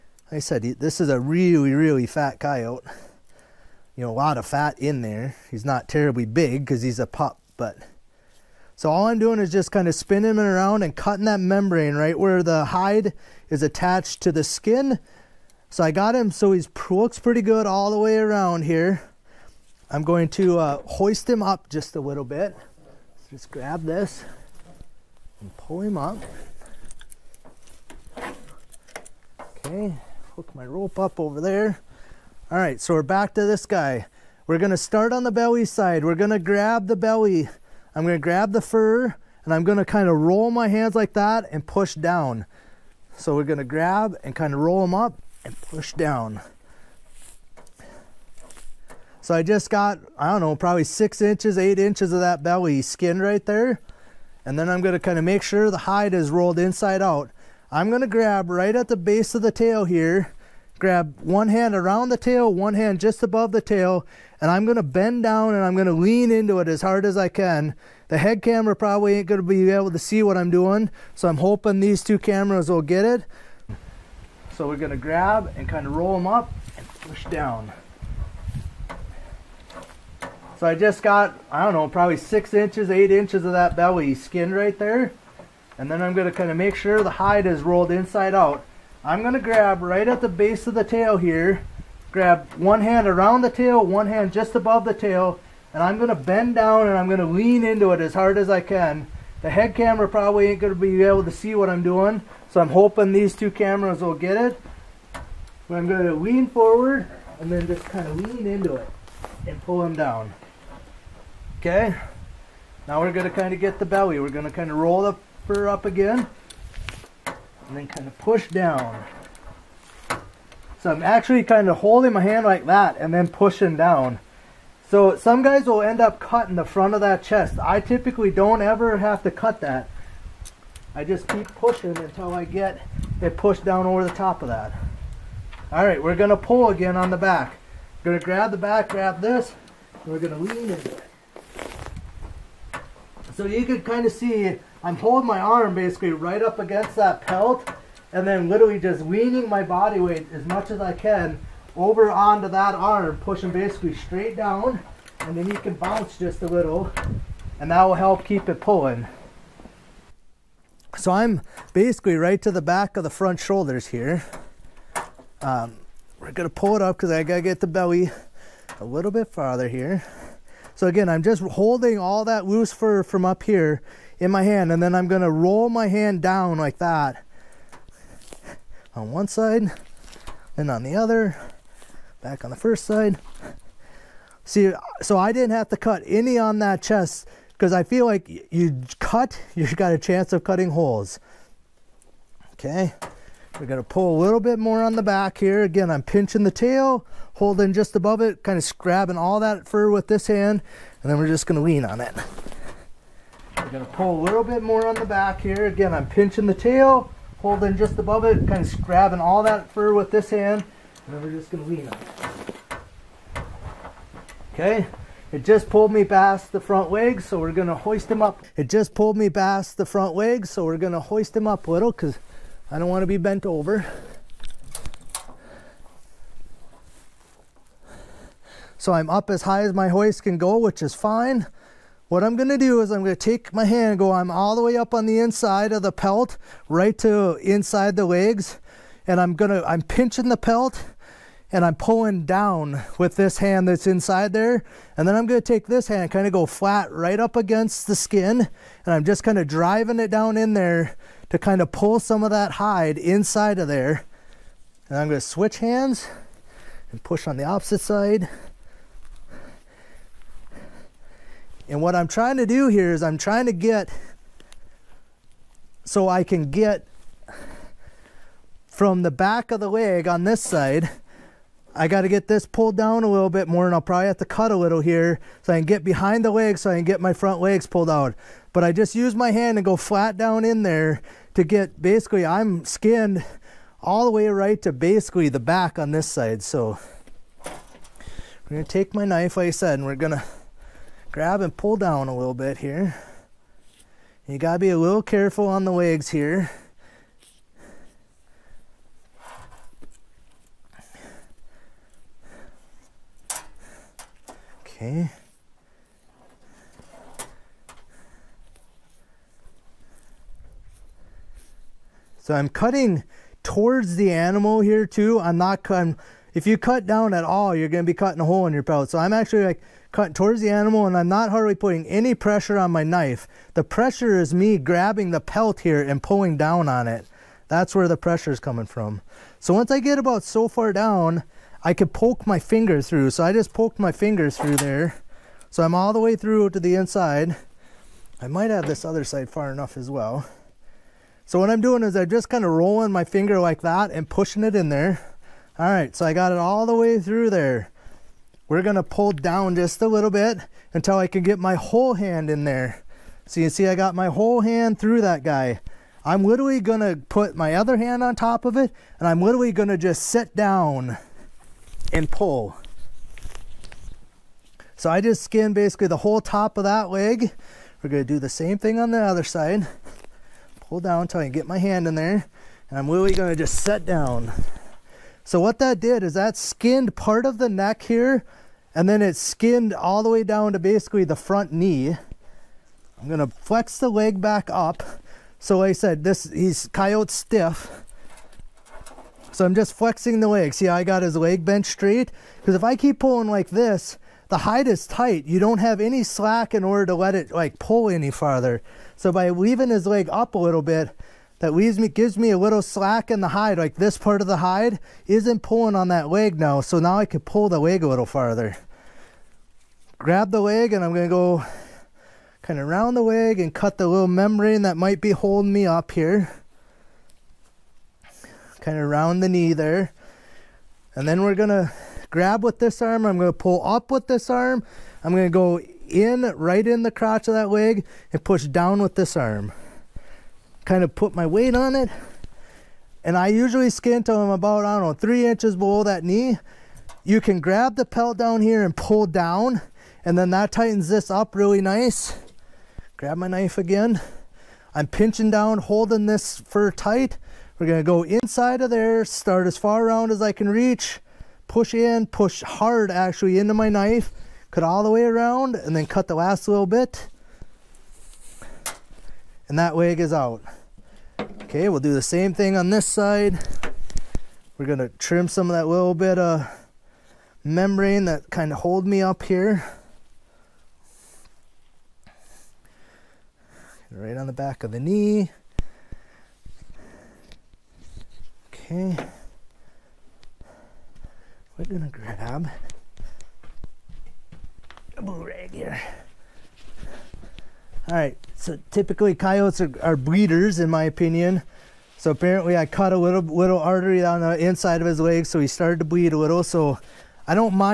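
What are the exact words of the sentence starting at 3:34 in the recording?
Okay, it just pulled me past the front legs, so we're gonna hoist him up.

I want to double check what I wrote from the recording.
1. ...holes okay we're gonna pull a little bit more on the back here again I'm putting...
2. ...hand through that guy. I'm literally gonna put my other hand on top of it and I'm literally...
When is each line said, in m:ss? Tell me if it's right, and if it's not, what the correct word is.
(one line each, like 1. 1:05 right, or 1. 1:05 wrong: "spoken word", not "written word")
1. 3:10 wrong: "pinching", not "putting"
2. 5:54 right.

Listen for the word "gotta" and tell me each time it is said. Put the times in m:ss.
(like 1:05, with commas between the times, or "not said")
2:47, 4:54.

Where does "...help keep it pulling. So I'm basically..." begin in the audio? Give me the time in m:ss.
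2:37.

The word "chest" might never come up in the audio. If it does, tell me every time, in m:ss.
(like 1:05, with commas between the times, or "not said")
2:07, 3:06.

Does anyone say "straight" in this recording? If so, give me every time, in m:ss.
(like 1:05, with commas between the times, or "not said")
2:33, 6:31.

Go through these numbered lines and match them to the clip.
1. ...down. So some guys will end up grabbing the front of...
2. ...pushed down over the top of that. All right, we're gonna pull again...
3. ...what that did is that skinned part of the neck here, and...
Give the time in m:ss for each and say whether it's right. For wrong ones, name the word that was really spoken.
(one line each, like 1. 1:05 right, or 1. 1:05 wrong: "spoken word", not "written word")
1. 2:03 wrong: "cutting", not "grabbing"
2. 2:13 right
3. 6:15 right.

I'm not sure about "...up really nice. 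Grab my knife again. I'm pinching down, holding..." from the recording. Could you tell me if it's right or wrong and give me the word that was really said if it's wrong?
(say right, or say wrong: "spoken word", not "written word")
right.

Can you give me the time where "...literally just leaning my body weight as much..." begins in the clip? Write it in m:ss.
2:28.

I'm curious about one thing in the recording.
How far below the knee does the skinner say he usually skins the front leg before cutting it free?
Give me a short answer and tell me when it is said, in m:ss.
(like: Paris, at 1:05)
3 inches, at 7:14.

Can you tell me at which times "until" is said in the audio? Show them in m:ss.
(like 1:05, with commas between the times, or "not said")
2:11, 5:50, 6:11.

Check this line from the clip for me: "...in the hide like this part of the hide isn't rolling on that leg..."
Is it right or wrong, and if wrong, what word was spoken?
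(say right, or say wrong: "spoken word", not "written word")
wrong: "pulling", not "rolling".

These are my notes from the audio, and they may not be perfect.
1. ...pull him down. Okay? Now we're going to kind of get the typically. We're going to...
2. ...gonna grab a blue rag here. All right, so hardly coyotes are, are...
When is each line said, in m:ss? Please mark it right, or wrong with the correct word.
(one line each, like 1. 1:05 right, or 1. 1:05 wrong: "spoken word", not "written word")
1. 1:49 wrong: "belly", not "typically"
2. 8:01 wrong: "typically", not "hardly".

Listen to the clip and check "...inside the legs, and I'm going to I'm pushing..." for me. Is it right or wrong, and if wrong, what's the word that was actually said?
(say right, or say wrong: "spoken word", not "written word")
wrong: "pinching", not "pushing".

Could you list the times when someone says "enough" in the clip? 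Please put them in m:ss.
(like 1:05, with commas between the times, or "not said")
5:39.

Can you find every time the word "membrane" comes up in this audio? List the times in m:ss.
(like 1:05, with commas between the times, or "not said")
0:11, 6:54, 7:47.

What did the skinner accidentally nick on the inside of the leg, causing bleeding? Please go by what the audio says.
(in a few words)
artery.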